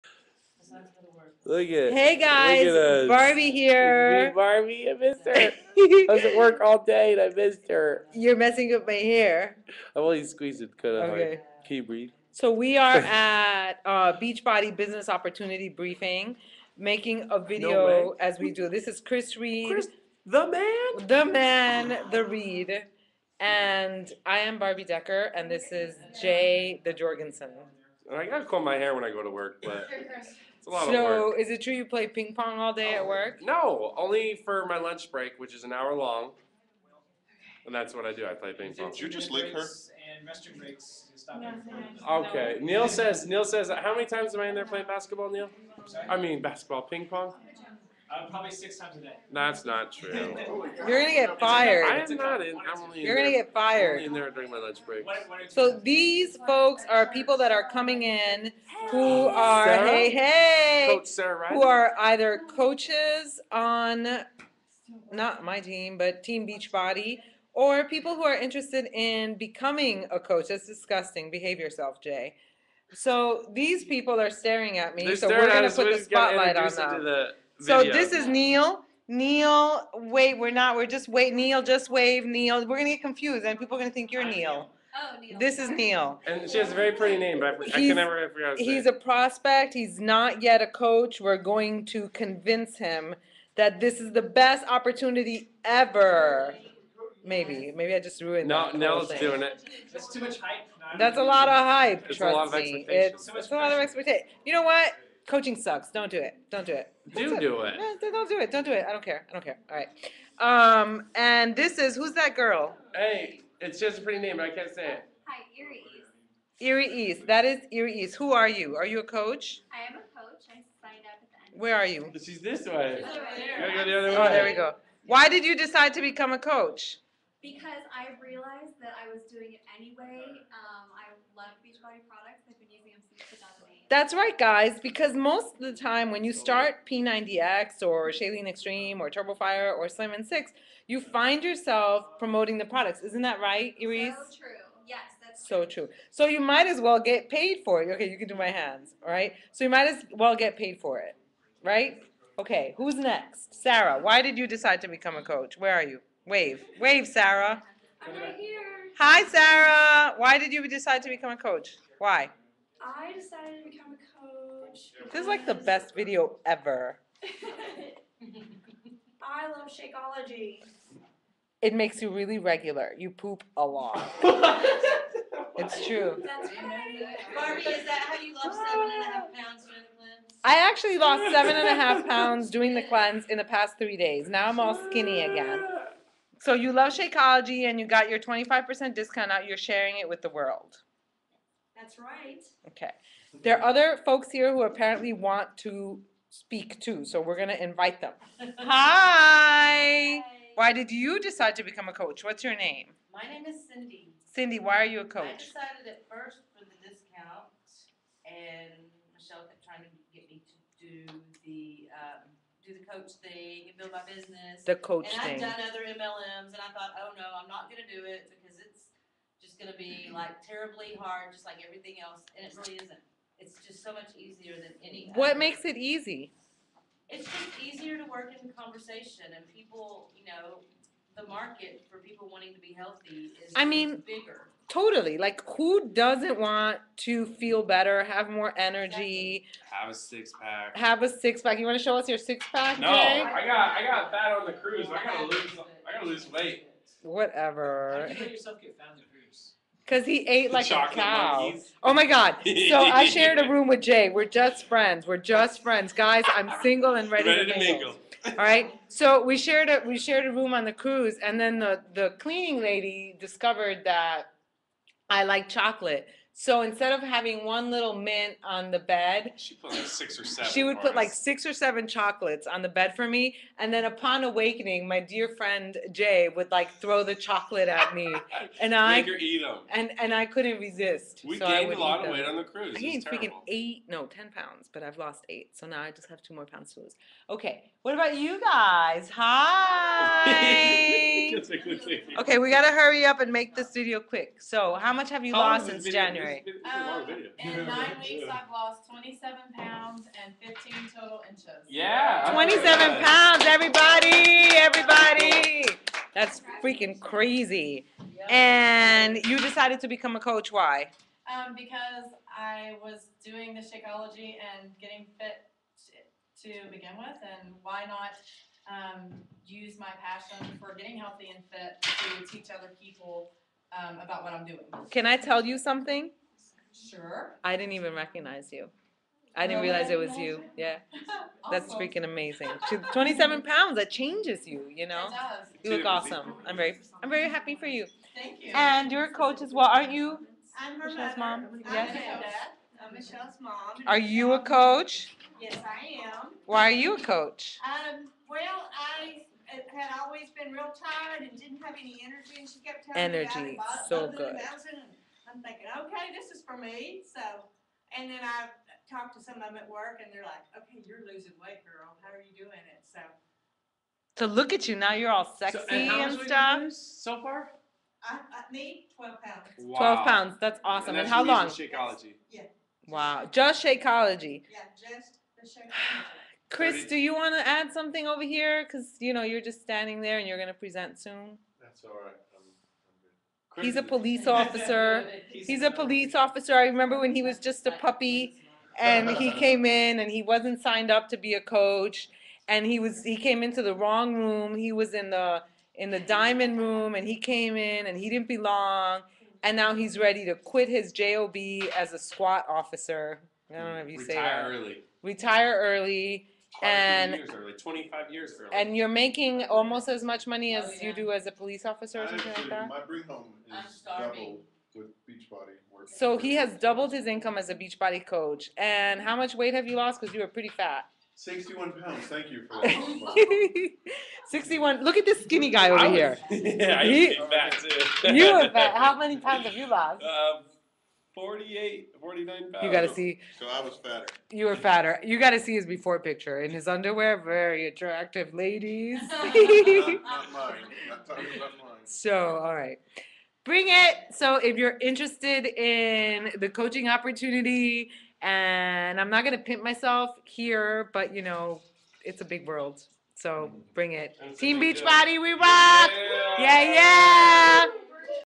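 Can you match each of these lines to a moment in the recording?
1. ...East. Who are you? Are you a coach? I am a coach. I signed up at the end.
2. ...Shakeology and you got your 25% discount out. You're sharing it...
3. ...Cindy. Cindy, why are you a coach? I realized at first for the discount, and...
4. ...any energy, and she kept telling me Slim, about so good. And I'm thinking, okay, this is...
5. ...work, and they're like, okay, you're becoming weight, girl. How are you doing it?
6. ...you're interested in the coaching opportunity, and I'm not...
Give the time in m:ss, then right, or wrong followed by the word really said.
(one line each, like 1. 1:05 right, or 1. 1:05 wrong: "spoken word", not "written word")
1. 1:58 right
2. 3:06 right
3. 3:23 wrong: "decided", not "realized"
4. 5:51 wrong: "Energy", not "Slim"
5. 5:59 wrong: "losing", not "becoming"
6. 7:24 right.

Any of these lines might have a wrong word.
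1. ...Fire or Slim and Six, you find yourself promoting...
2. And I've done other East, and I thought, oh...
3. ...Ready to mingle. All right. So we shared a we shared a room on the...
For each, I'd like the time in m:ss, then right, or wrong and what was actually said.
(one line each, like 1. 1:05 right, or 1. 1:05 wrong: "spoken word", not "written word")
1. 2:19 right
2. 3:35 wrong: "MLMs", not "East"
3. 4:17 right.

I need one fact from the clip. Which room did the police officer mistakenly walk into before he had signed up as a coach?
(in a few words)
The diamond room.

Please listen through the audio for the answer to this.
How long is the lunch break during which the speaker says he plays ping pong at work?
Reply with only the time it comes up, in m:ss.
0:35.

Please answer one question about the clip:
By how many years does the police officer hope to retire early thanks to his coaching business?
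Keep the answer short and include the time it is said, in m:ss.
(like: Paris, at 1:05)
25 years, at 6:47.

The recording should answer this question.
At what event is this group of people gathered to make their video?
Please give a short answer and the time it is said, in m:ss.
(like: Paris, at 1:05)
Beachbody Business Opportunity Briefing, at 0:14.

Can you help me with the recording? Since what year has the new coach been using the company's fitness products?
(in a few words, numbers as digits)
2008.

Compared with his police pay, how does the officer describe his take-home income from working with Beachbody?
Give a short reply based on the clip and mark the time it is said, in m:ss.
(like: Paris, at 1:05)
Double, at 6:53.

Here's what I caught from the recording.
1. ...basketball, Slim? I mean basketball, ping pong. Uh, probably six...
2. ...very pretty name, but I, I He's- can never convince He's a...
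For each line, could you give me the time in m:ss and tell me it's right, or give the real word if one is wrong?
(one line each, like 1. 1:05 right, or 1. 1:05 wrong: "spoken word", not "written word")
1. 0:44 wrong: "Neil", not "Slim"
2. 1:26 wrong: "pronounce", not "convince".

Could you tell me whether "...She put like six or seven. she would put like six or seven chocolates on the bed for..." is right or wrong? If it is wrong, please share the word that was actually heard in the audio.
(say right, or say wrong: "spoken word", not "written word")
right.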